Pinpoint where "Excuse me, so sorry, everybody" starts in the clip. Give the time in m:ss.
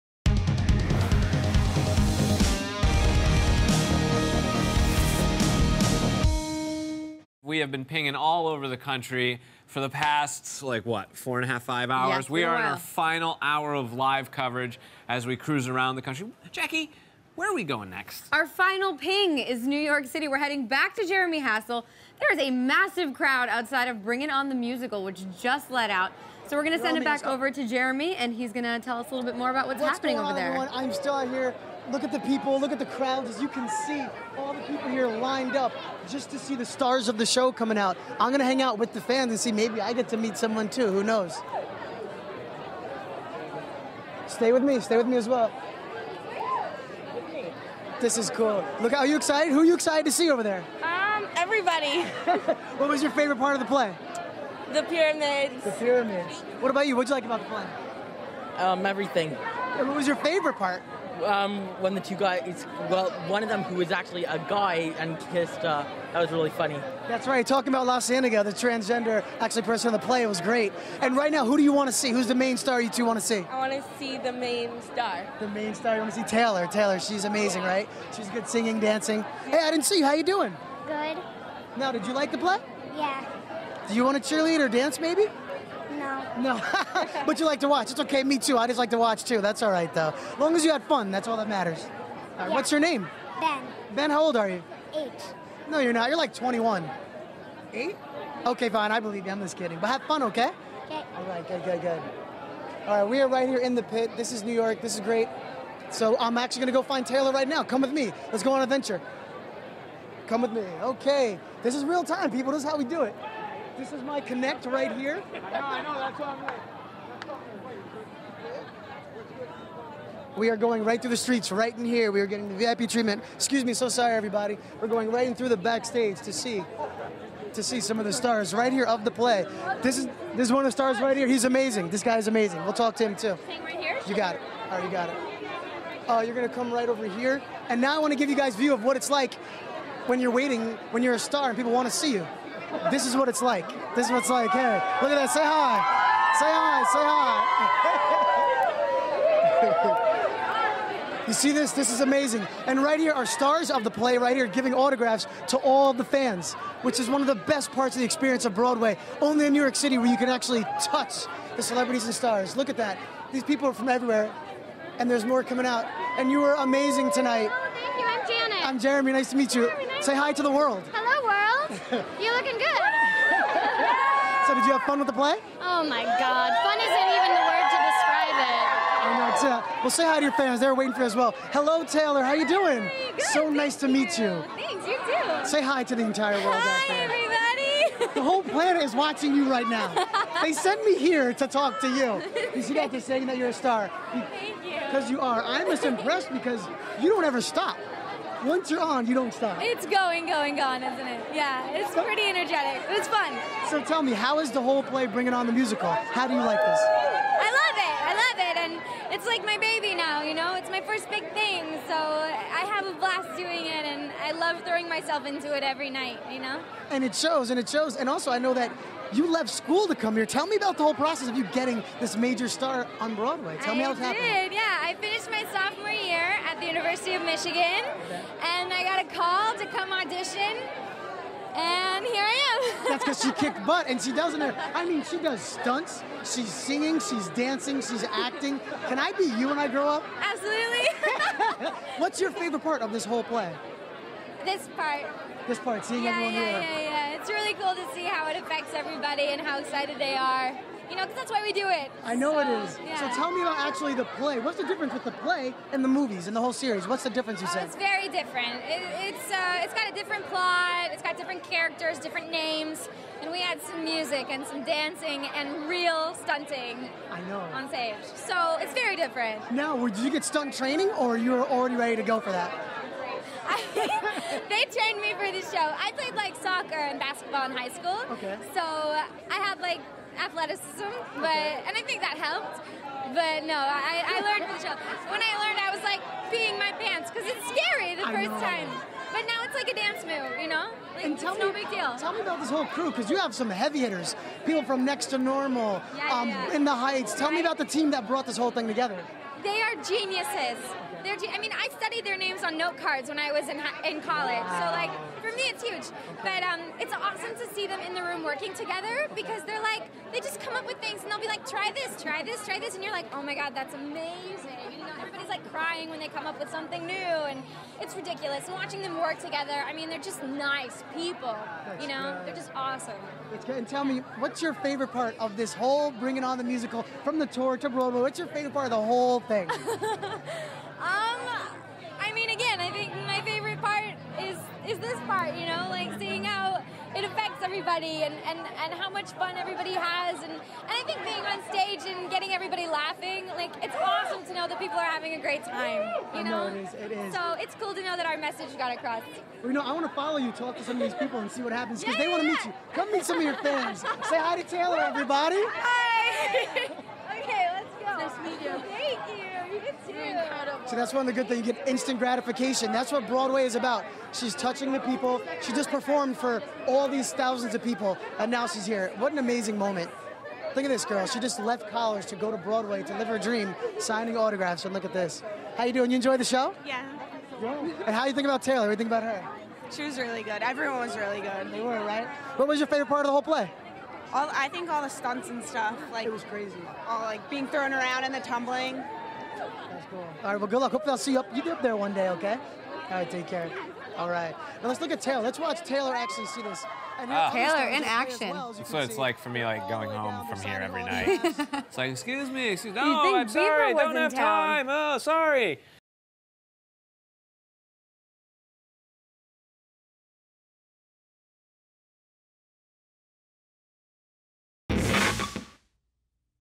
2:03.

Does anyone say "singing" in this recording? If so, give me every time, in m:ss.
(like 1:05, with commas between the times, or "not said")
1:18, 3:56.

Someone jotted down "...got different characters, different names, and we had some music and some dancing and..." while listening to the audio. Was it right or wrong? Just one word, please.
right.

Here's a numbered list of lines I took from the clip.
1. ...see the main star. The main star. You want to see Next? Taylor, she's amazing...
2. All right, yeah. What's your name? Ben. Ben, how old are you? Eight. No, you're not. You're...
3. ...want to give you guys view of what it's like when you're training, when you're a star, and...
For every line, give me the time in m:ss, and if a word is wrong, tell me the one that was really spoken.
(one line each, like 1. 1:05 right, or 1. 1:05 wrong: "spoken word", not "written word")
1. 1:13 wrong: "Taylor", not "Next"
2. 1:32 right
3. 2:17 wrong: "waiting", not "training".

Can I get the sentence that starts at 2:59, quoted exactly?
I know, it's, uh, well, say hi to your fans.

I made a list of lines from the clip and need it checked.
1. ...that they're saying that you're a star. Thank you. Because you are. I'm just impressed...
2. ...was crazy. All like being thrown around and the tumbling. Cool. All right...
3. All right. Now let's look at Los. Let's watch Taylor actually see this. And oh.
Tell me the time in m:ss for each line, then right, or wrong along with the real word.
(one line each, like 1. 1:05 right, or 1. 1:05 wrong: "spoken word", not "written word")
1. 3:12 right
2. 6:26 right
3. 6:33 wrong: "Taylor", not "Los".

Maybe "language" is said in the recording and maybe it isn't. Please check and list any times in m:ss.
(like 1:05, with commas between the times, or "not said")
not said.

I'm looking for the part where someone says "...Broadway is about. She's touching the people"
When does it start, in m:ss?
6:03.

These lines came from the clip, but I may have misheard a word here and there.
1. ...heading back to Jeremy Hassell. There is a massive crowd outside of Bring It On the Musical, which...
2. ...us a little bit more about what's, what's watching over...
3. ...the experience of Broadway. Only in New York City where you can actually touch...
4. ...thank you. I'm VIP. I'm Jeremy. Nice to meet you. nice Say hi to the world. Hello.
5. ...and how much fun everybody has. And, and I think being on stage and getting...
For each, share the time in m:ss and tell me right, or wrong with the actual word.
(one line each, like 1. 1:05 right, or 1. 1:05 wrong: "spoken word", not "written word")
1. 0:20 right
2. 0:28 wrong: "happening", not "watching"
3. 2:37 right
4. 2:47 wrong: "Janet", not "VIP"
5. 5:38 right.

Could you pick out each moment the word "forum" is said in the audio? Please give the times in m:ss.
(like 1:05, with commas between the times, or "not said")
not said.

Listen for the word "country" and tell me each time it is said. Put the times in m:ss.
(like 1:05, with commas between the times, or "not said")
0:08, 0:16.